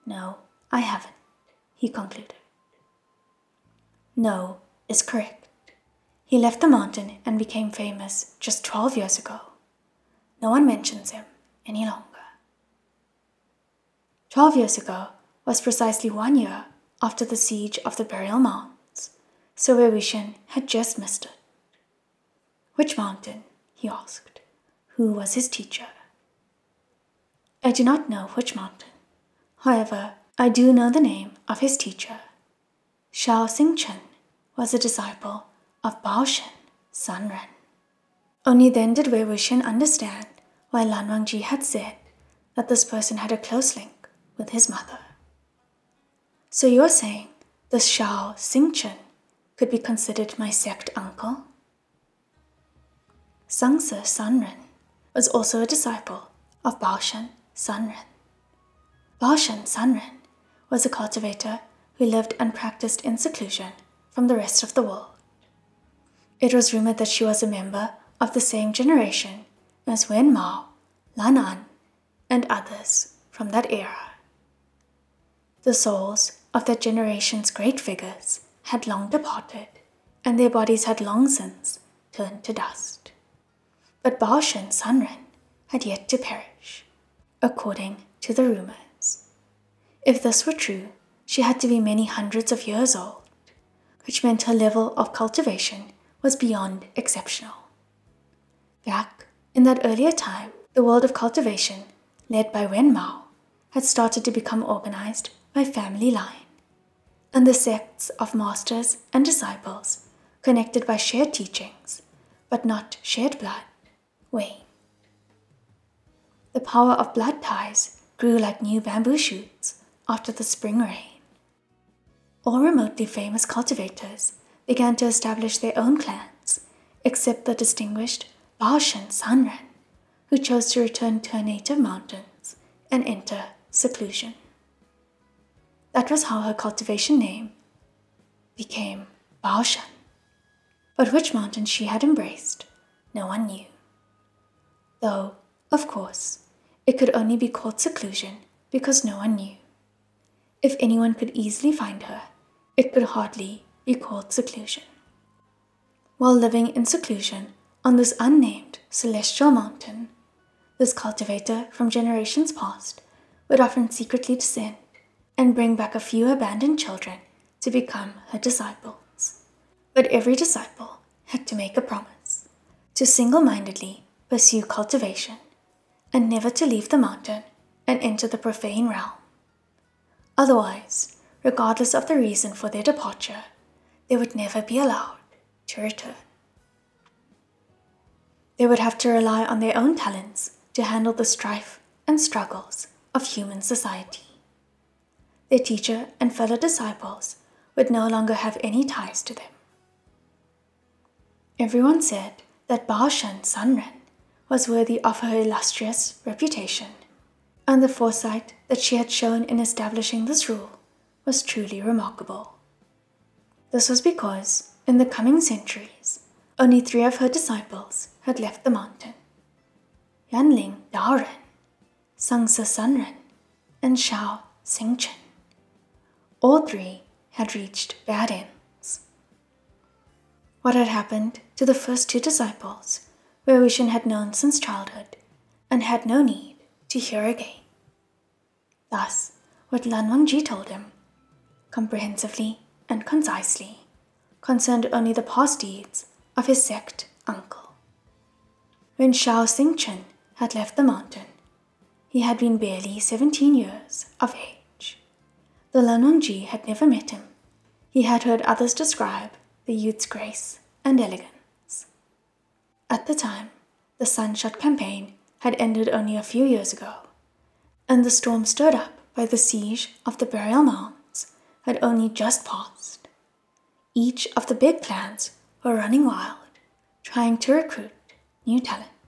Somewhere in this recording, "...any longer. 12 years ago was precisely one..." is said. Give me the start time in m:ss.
0:11.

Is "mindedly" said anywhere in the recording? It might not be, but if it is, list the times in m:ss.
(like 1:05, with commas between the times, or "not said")
2:53.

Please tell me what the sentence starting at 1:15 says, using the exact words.
The souls of that generation's great figures had long departed, and their bodies had long since turned to dust.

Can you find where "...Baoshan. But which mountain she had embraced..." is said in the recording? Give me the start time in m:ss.
2:19.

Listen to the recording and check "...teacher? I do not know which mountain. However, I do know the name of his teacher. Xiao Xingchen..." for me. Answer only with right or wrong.
right.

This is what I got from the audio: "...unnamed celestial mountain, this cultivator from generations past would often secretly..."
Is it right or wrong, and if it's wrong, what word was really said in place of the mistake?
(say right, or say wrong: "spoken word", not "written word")
right.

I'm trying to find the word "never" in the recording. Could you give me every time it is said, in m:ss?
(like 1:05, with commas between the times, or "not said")
2:56, 3:04, 4:16.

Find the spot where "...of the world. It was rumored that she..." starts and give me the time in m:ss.
1:04.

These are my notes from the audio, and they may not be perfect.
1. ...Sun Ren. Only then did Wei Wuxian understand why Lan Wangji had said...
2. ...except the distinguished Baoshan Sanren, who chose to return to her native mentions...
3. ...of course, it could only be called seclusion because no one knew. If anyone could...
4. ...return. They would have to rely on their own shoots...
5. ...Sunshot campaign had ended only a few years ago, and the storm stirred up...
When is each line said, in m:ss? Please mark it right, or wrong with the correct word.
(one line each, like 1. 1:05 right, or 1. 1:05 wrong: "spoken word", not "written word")
1. 0:36 right
2. 2:07 wrong: "mountains", not "mentions"
3. 2:25 right
4. 3:05 wrong: "talents", not "shoots"
5. 4:24 right.